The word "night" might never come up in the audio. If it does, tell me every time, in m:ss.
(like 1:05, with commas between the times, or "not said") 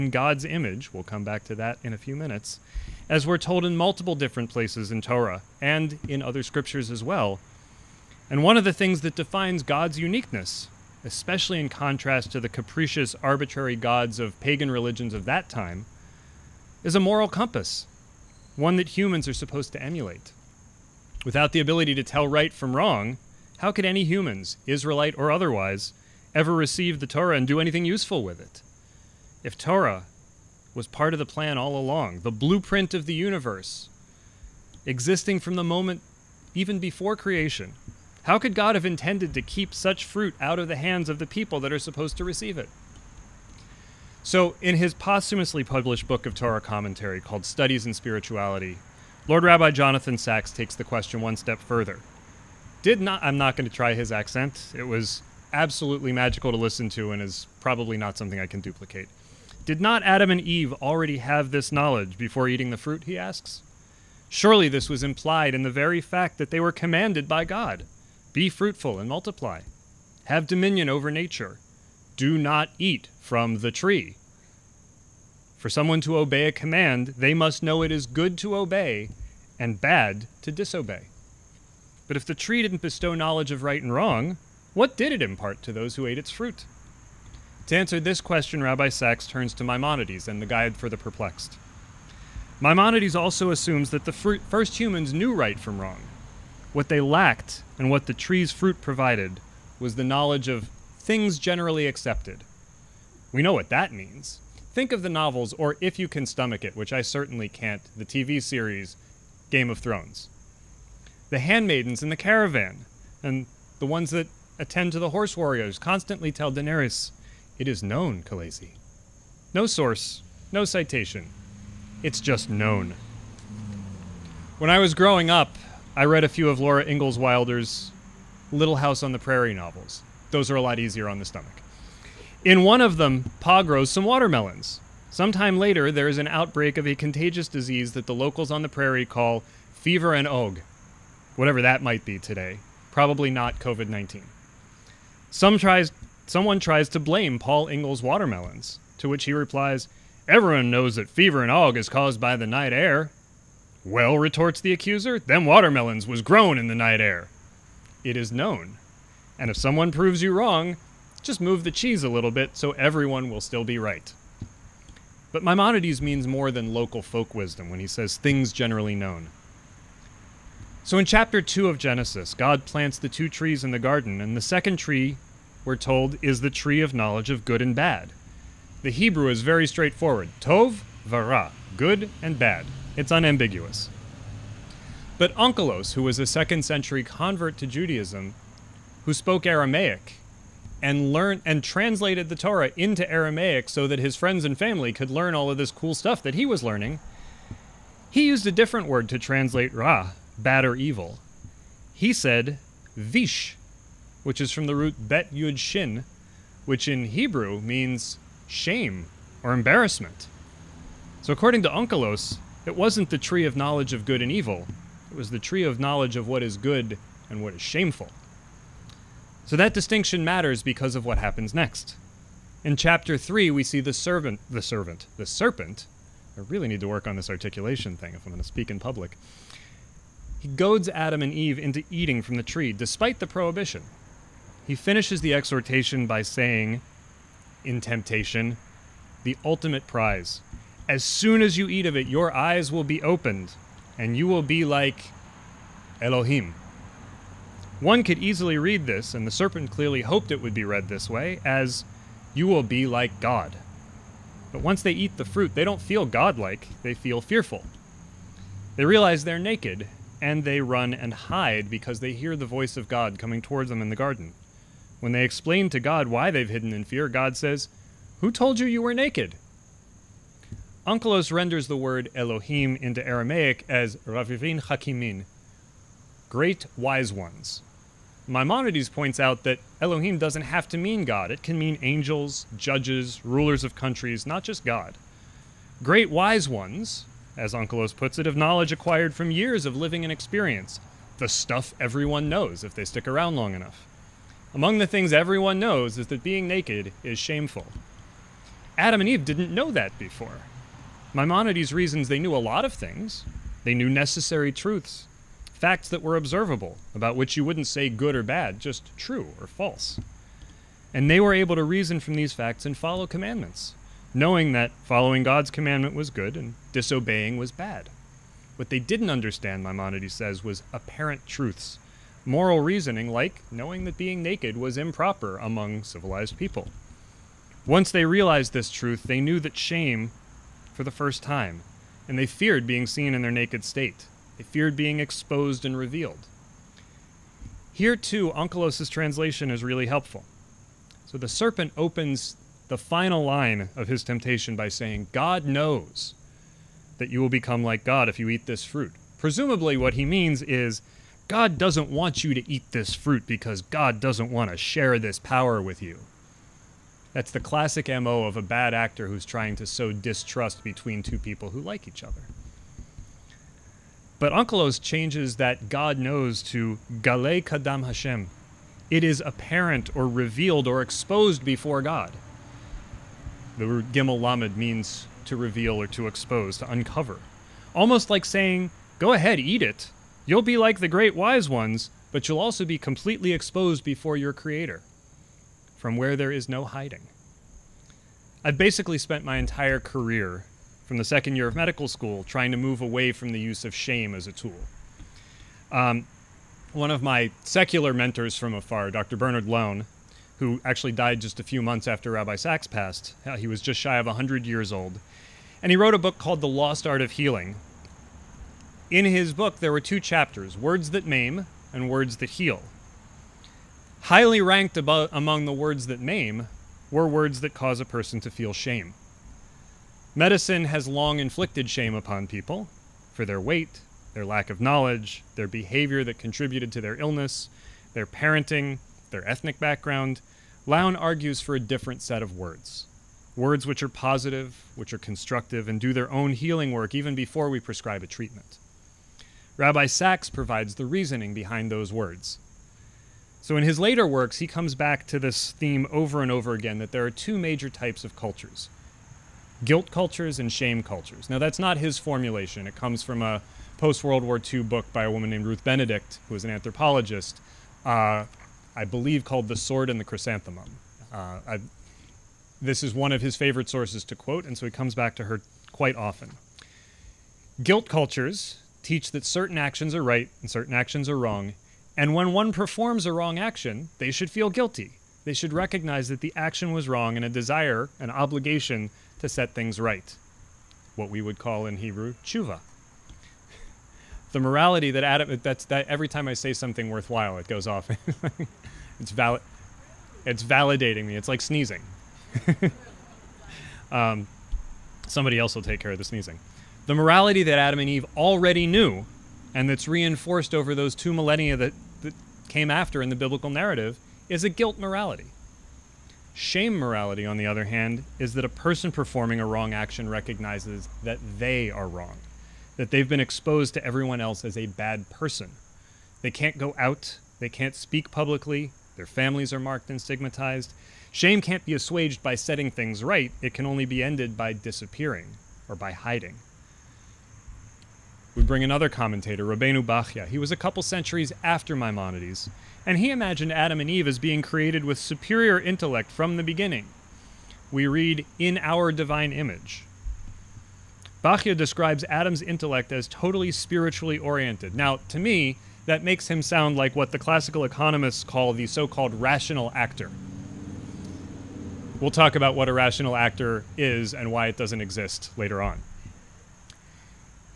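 2:32, 2:36.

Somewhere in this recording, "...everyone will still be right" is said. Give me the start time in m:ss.
2:42.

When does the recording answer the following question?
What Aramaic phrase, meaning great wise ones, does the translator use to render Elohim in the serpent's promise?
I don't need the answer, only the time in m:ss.
4:33.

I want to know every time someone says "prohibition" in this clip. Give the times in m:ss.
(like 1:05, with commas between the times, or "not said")
3:53.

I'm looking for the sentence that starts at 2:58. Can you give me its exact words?
The Hebrew is very straightforward Tov, Vara, good and bad.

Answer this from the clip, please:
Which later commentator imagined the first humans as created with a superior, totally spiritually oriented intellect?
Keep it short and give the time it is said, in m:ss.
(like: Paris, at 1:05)
Rabbeinu Bachya, at 8:49.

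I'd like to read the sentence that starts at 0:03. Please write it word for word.
As we're told in multiple different places in Torah and in other scriptures as well.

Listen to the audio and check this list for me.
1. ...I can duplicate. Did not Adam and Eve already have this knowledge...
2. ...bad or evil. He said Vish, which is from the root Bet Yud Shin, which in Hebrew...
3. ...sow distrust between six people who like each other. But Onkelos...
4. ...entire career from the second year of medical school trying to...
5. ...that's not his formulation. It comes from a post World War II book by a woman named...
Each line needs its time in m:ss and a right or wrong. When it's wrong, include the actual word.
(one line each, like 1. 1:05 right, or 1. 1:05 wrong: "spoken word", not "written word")
1. 0:58 right
2. 3:20 right
3. 5:59 wrong: "two", not "six"
4. 6:29 right
5. 7:31 right.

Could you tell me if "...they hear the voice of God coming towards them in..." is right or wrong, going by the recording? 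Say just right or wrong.
right.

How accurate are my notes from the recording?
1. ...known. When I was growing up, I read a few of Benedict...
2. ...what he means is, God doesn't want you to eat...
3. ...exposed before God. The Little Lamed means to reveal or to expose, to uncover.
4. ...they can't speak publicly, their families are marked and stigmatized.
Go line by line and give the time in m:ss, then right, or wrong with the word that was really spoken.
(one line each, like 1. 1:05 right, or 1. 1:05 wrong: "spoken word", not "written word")
1. 2:02 wrong: "Laura", not "Benedict"
2. 5:49 right
3. 6:10 wrong: "Gimel", not "Little"
4. 8:37 right.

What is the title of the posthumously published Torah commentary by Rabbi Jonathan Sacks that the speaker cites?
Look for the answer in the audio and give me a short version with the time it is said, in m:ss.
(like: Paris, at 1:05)
Studies in Spirituality, at 0:47.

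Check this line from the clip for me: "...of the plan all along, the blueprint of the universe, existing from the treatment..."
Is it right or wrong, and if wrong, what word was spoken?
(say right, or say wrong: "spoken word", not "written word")
wrong: "moment", not "treatment".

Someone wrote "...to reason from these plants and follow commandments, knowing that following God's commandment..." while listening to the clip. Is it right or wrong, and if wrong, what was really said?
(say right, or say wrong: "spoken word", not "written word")
wrong: "facts", not "plants".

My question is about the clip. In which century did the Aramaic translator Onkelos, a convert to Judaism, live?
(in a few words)
Second century.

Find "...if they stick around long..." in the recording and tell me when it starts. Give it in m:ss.
4:52.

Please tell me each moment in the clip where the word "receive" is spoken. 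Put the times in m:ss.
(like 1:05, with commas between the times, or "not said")
0:26, 0:42.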